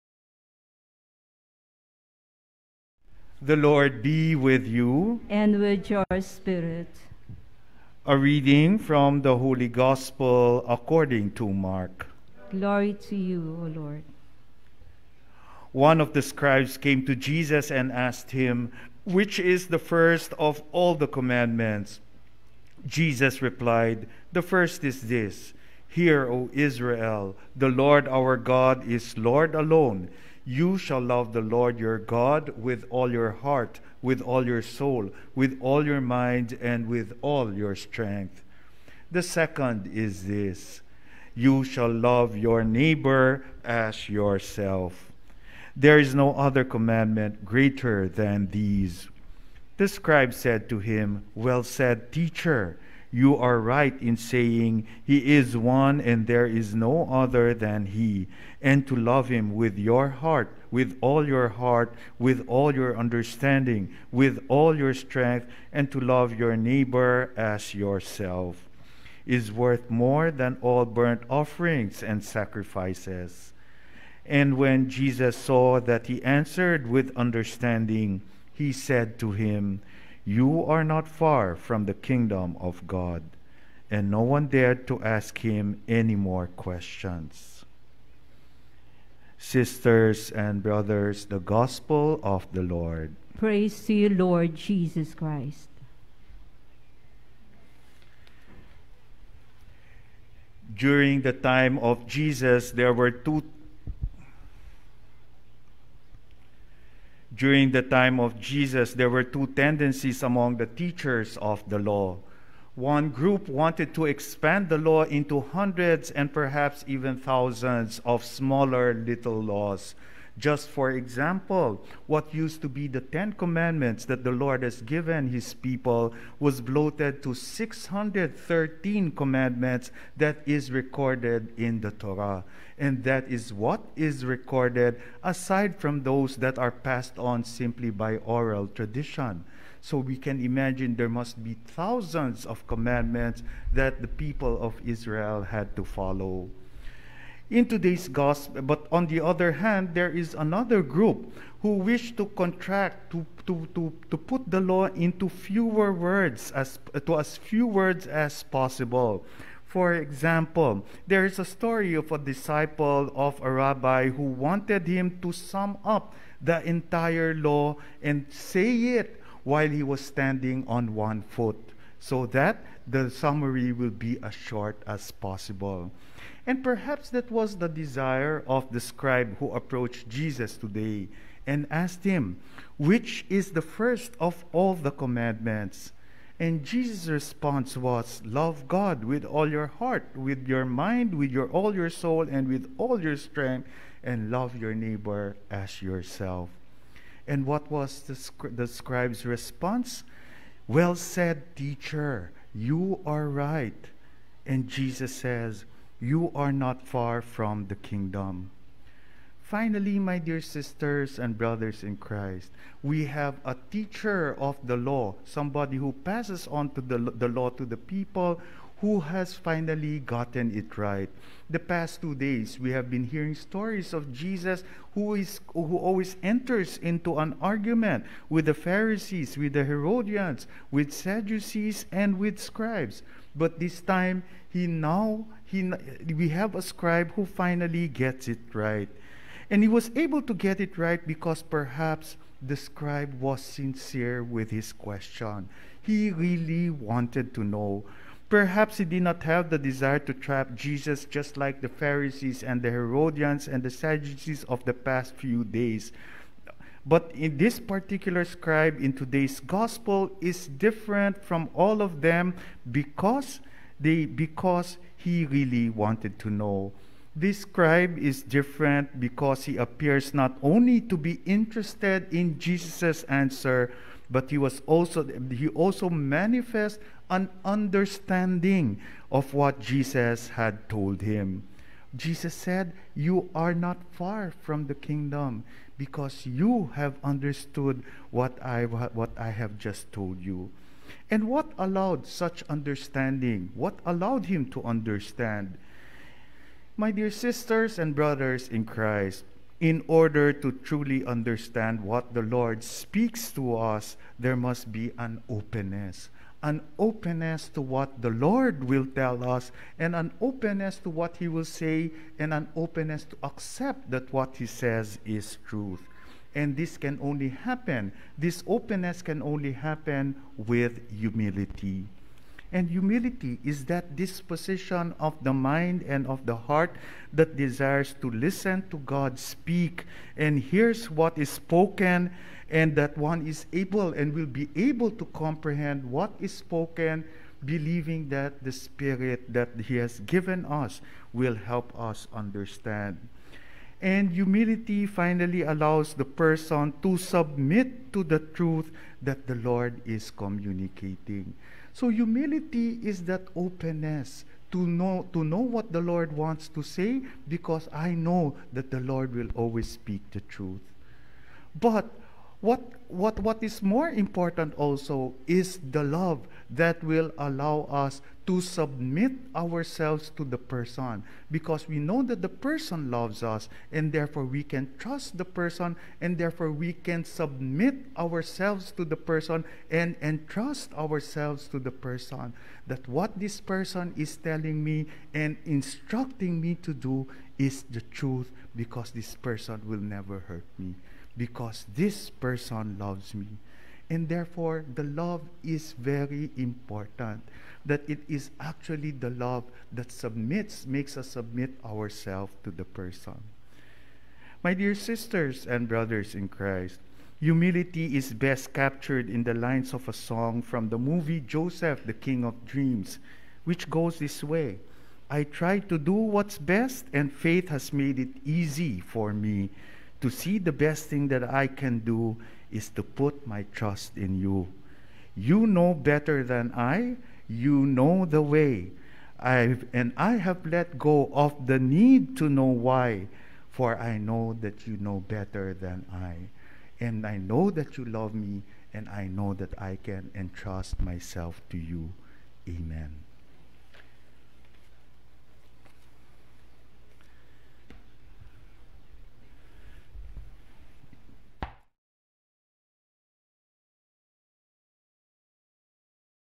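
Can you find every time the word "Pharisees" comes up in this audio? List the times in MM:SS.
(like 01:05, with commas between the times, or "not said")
03:48, 04:11.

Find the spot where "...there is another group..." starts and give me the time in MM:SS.
02:29.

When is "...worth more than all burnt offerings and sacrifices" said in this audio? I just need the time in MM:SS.
01:09.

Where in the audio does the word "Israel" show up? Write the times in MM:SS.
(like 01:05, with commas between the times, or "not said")
00:26, 02:24.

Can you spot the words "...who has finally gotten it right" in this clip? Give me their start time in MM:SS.
03:38.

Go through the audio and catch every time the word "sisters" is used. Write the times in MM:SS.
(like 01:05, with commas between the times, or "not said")
01:29, 03:30, 04:57, 06:44.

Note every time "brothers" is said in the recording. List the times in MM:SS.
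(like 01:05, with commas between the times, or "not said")
01:30, 03:31, 04:57, 06:45.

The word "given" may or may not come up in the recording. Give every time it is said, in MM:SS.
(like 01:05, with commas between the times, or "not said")
02:04, 05:40.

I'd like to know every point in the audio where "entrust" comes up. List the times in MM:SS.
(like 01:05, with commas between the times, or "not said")
06:20, 07:20.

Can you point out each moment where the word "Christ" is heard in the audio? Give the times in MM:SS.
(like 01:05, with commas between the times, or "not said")
01:35, 03:31, 04:58, 06:46.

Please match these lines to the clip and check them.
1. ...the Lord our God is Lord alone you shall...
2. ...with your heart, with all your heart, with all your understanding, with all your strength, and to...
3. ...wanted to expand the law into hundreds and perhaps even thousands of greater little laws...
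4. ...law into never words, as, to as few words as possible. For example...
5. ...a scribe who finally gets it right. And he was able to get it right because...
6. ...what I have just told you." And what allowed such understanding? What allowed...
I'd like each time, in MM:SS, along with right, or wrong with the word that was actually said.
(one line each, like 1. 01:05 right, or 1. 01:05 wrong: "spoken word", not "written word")
1. 00:27 right
2. 00:59 right
3. 01:53 wrong: "smaller", not "greater"
4. 02:34 wrong: "fewer", not "never"
5. 03:56 right
6. 04:48 right.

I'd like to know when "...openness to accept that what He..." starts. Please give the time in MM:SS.
05:12.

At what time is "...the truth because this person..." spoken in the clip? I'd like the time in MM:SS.
06:27.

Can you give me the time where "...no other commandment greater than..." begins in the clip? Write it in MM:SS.
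00:46.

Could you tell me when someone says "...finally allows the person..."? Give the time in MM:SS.
05:44.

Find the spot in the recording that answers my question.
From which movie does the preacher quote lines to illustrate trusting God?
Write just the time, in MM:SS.
06:51.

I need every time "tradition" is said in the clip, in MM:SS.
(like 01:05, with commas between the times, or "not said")
02:18.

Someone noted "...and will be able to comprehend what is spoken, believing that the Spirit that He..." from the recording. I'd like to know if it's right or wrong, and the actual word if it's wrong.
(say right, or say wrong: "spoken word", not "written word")
right.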